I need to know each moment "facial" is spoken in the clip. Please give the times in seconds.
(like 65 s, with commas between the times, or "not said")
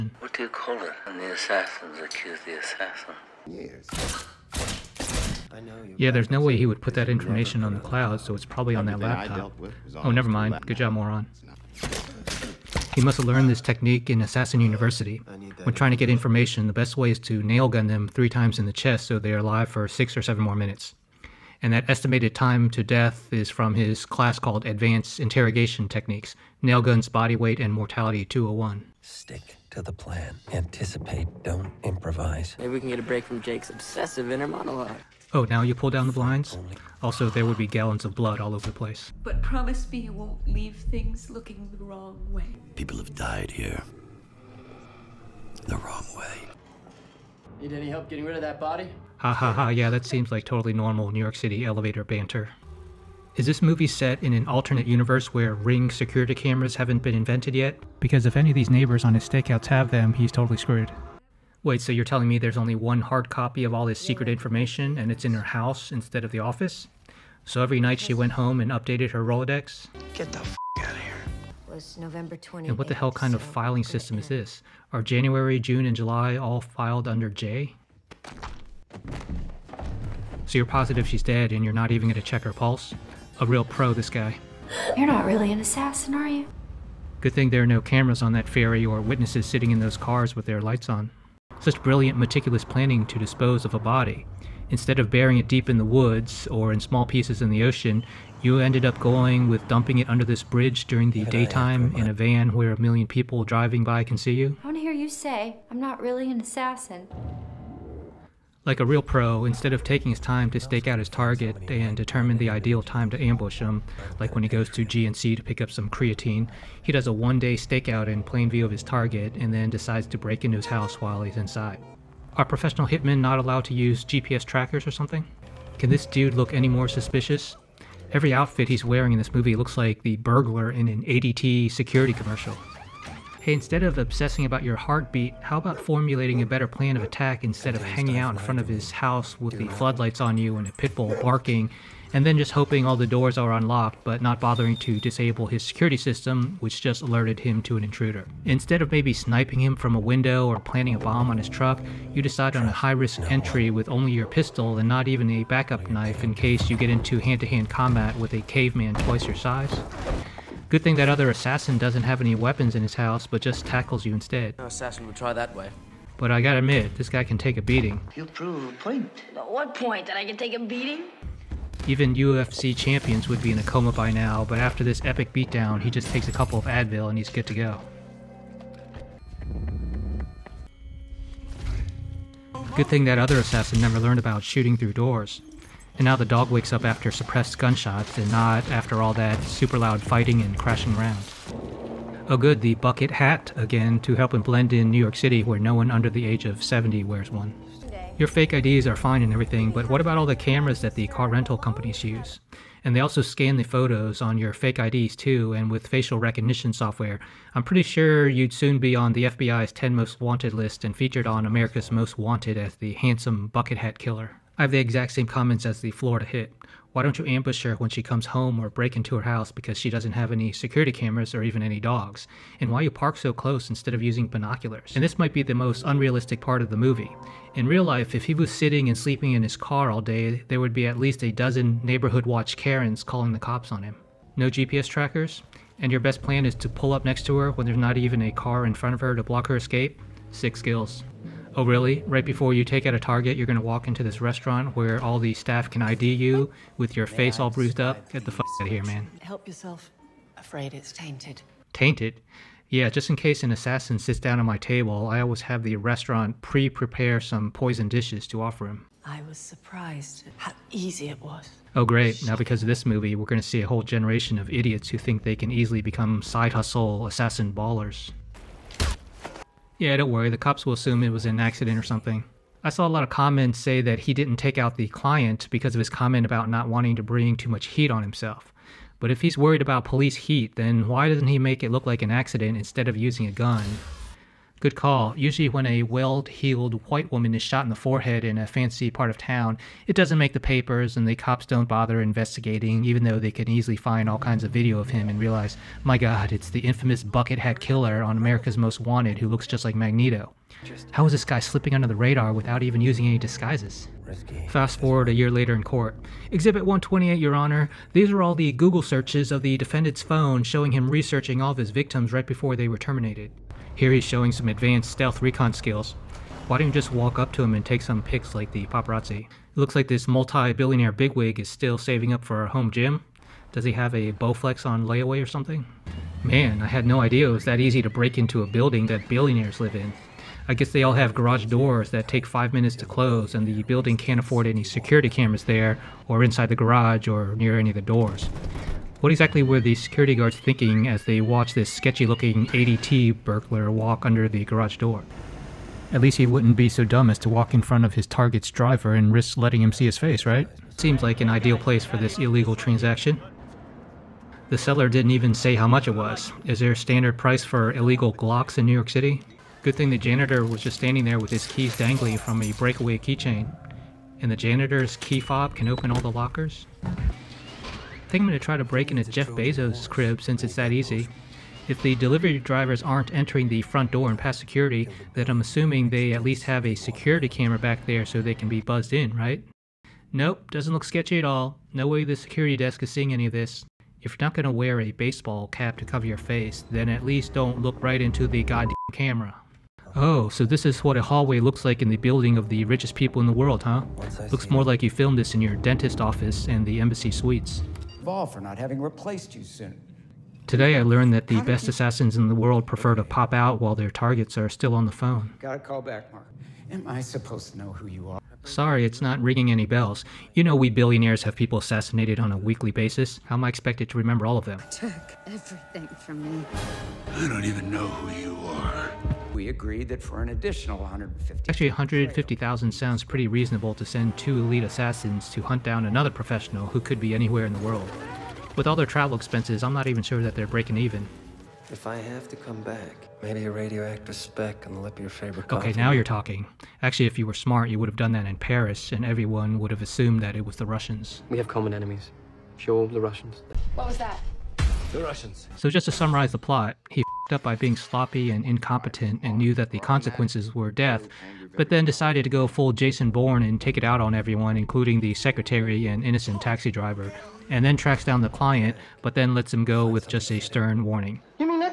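205 s.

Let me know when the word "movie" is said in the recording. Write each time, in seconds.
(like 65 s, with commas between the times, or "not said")
53 s, 129 s, 226 s, 262 s.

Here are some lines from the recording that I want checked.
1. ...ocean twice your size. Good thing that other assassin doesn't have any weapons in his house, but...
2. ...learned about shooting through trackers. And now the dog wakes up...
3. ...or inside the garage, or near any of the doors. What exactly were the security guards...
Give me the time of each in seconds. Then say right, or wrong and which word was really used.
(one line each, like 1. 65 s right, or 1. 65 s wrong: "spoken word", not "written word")
1. 158 s wrong: "caveman", not "ocean"
2. 183 s wrong: "doors", not "trackers"
3. 336 s right.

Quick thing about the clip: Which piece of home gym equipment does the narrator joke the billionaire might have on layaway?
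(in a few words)
Bowflex.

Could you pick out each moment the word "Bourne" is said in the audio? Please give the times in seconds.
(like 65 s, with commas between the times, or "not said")
453 s.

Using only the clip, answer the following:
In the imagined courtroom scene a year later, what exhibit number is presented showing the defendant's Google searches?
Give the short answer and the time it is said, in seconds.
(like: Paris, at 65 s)
128, at 306 s.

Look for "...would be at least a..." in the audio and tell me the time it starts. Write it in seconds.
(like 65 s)
230 s.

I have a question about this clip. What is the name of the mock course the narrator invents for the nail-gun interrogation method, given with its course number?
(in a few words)
Mortality 201.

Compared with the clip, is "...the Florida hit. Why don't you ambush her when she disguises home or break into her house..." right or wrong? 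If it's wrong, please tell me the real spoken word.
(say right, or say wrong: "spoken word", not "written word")
wrong: "comes", not "disguises".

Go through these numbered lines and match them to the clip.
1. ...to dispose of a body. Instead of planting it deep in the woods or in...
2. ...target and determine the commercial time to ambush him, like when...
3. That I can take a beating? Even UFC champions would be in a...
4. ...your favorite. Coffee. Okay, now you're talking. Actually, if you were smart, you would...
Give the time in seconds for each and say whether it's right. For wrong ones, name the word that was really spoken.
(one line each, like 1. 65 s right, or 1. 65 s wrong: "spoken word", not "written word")
1. 93 s wrong: "burying", not "planting"
2. 111 s wrong: "ideal", not "commercial"
3. 170 s right
4. 434 s right.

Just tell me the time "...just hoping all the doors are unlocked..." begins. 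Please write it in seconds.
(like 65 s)
142 s.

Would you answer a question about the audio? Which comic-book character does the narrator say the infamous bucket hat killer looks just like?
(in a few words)
Magneto.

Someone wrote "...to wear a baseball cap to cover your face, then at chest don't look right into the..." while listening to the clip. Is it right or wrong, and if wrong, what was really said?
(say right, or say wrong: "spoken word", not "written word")
wrong: "least", not "chest".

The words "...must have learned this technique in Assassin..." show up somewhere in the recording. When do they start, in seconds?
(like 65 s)
13 s.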